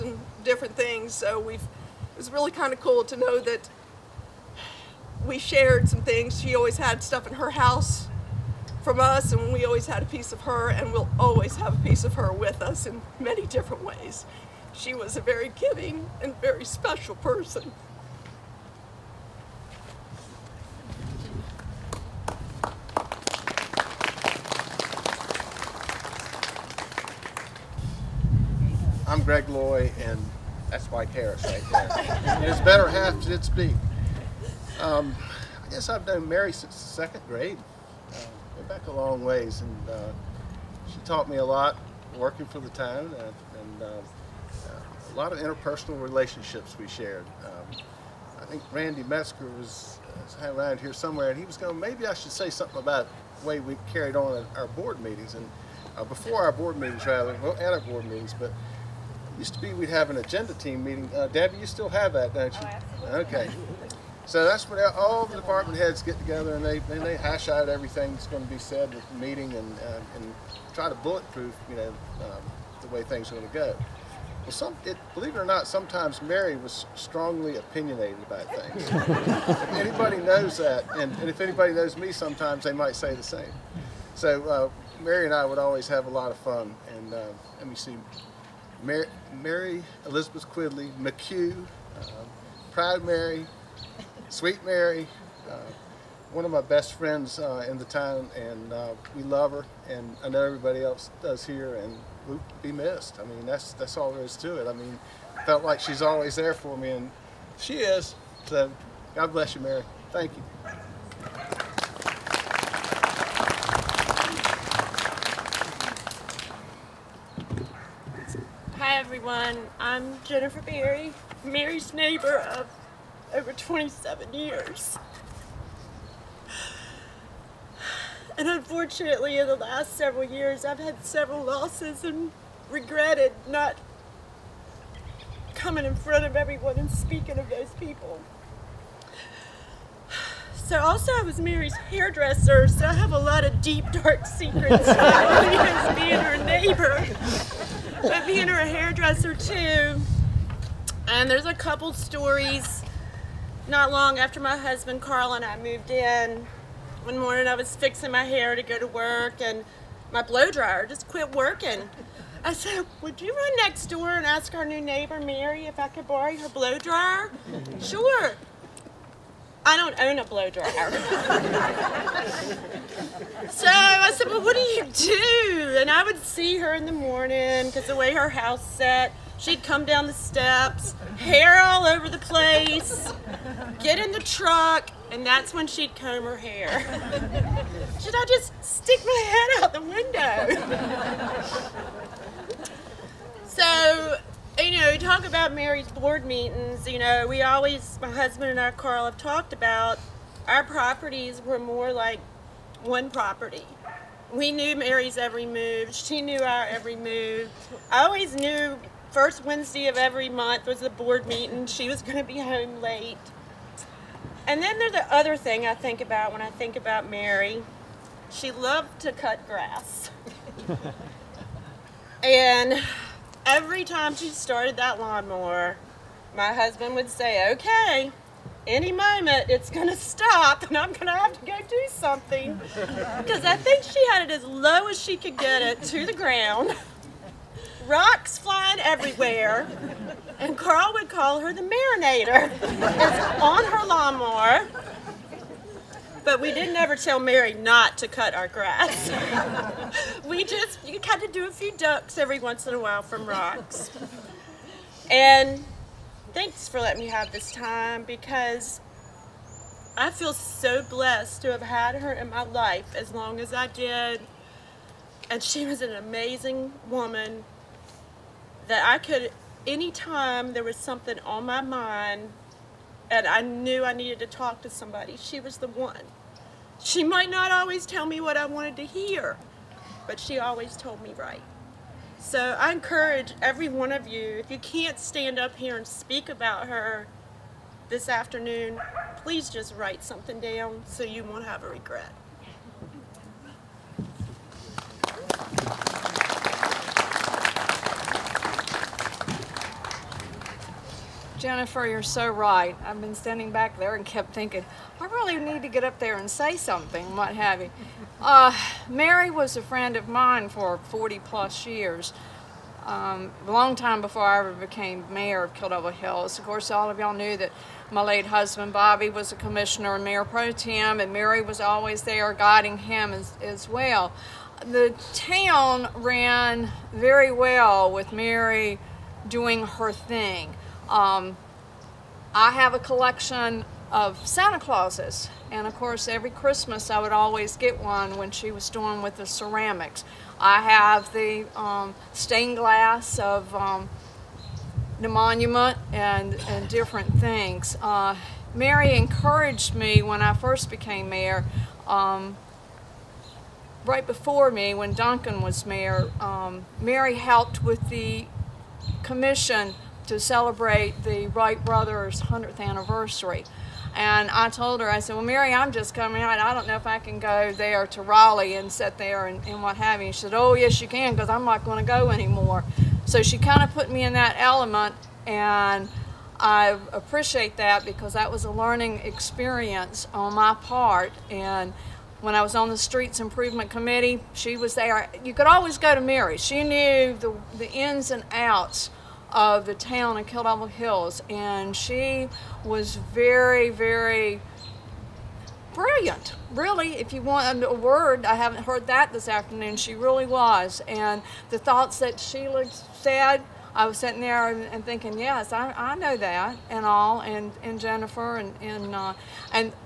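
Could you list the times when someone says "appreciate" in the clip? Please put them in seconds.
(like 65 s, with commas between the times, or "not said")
376 s.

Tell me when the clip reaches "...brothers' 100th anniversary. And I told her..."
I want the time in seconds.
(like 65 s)
361 s.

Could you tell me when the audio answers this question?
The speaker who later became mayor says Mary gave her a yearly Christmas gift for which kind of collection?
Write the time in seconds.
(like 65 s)
334 s.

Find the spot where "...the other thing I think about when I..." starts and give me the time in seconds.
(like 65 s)
214 s.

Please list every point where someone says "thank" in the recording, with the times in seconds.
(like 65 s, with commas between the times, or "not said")
110 s, 256 s.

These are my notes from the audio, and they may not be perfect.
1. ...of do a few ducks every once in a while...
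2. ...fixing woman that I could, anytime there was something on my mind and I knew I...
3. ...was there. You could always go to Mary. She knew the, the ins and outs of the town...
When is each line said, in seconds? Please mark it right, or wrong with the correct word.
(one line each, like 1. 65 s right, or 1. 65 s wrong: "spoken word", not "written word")
1. 251 s right
2. 265 s wrong: "amazing", not "fixing"
3. 384 s right.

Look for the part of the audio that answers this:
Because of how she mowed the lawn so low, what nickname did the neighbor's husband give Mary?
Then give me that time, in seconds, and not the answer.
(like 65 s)
241 s.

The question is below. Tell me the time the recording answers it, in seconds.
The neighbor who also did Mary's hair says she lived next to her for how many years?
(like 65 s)
123 s.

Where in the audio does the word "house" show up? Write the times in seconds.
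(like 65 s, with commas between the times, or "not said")
7 s, 178 s.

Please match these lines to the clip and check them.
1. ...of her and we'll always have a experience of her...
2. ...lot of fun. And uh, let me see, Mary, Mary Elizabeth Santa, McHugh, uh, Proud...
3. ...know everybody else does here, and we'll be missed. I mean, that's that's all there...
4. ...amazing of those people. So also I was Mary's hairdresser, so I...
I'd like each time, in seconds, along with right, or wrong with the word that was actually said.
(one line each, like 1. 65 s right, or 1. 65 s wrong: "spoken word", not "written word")
1. 10 s wrong: "piece", not "experience"
2. 86 s wrong: "Quidley", not "Santa"
3. 100 s right
4. 136 s wrong: "speaking", not "amazing".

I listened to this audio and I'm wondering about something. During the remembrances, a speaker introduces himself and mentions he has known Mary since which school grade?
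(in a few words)
Second grade.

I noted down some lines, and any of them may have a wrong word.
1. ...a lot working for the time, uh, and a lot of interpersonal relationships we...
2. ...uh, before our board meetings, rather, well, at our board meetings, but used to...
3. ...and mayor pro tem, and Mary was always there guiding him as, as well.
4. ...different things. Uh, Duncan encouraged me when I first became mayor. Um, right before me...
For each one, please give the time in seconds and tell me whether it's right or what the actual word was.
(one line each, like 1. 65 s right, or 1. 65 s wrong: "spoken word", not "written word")
1. 41 s right
2. 55 s right
3. 319 s right
4. 346 s wrong: "Mary", not "Duncan".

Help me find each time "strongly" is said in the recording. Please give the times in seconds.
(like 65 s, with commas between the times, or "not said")
76 s.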